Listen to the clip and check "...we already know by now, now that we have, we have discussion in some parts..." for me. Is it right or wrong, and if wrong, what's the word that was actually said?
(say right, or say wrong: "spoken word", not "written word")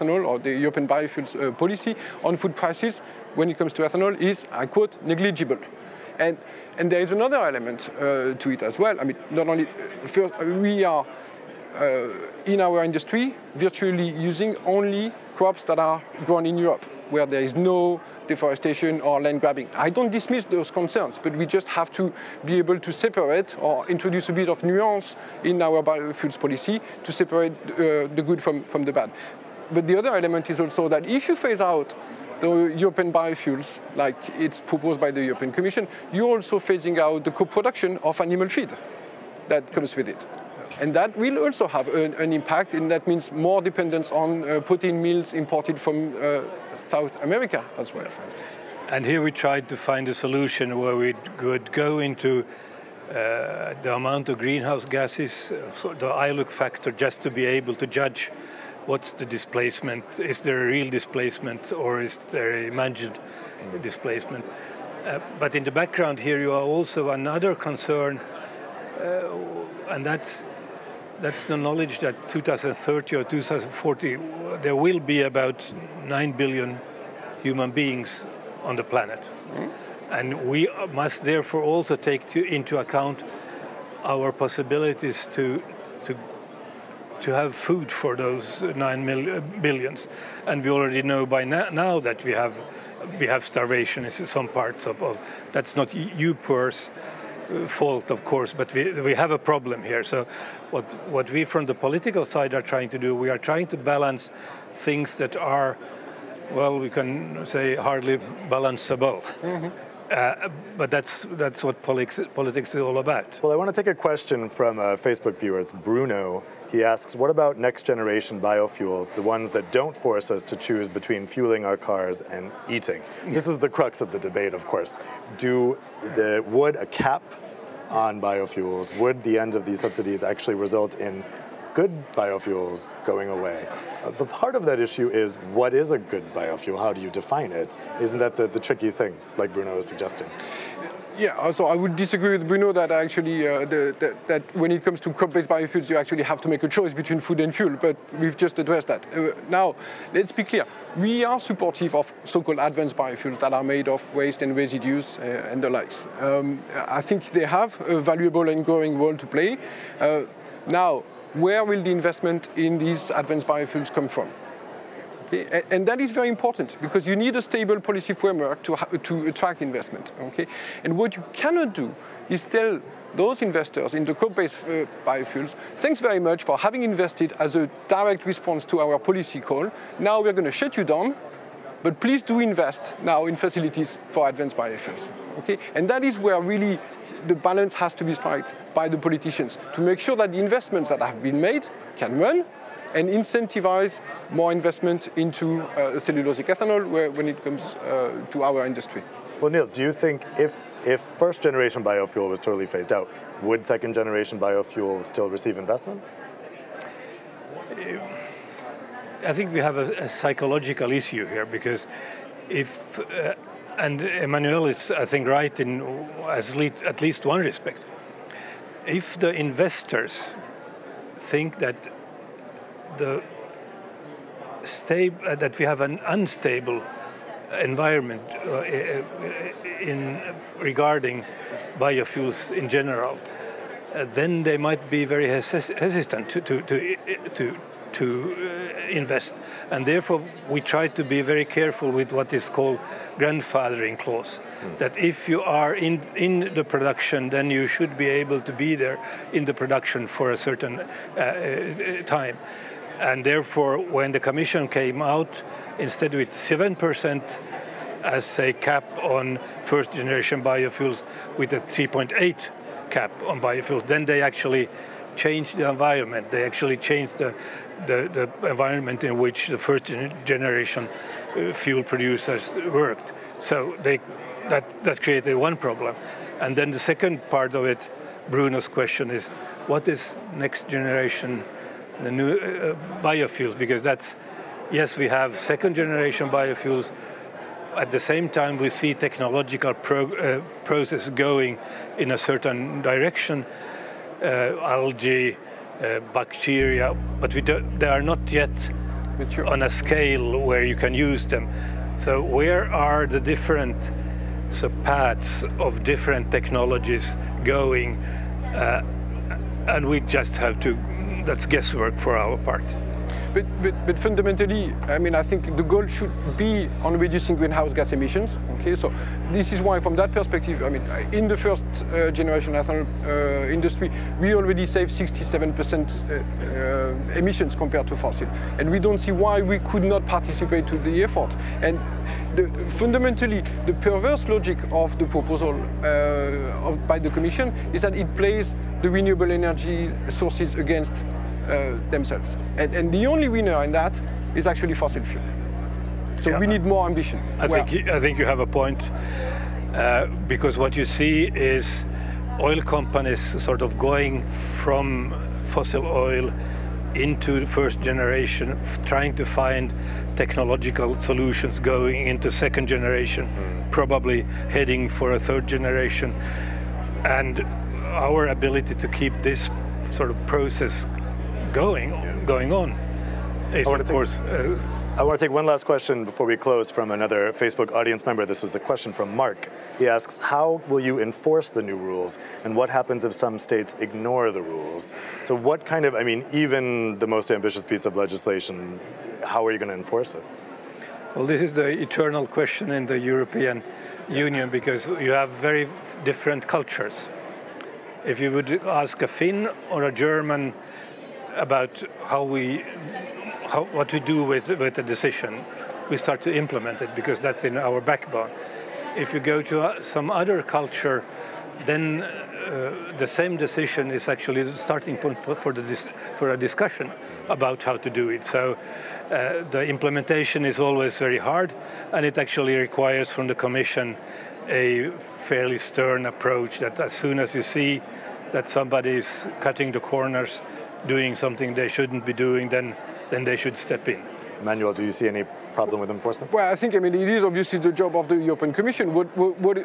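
wrong: "starvation", not "discussion".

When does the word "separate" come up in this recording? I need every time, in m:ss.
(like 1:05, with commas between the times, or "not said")
0:22, 0:27.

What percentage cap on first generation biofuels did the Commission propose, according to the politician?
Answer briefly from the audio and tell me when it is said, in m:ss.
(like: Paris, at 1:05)
7%, at 4:16.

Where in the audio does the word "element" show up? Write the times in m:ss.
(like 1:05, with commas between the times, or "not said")
0:07, 0:30.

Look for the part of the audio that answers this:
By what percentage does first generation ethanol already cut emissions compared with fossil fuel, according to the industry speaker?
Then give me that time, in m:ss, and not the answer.
5:24.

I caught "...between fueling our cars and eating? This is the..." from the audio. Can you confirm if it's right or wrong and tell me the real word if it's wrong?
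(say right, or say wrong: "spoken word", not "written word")
right.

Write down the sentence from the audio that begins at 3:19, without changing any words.
Well, Nils, do you think if, if first generation biofuel was totally phased out, would second generation biofuel still receive investment?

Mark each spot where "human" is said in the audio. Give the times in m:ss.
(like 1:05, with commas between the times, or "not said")
1:17.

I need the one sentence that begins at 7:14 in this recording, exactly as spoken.
Manuel, do you see any problem with enforcement?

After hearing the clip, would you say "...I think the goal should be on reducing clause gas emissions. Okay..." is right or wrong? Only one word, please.
wrong.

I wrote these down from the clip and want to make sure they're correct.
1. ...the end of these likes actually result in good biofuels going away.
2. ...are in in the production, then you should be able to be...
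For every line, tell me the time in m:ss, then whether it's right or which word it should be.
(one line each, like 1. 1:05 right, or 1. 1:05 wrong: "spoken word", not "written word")
1. 2:09 wrong: "subsidies", not "likes"
2. 4:05 right.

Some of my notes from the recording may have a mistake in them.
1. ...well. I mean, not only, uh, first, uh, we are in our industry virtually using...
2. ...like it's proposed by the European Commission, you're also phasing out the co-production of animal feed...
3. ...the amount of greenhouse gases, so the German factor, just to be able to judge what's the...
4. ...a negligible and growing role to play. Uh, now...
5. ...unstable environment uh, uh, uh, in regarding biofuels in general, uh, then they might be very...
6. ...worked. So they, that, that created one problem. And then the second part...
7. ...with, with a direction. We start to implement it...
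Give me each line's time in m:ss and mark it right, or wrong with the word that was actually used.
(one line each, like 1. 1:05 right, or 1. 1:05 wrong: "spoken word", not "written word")
1. 0:08 right
2. 0:33 right
3. 0:53 wrong: "ILUC", not "German"
4. 2:37 wrong: "valuable", not "negligible"
5. 3:46 right
6. 4:32 right
7. 6:44 wrong: "decision", not "direction".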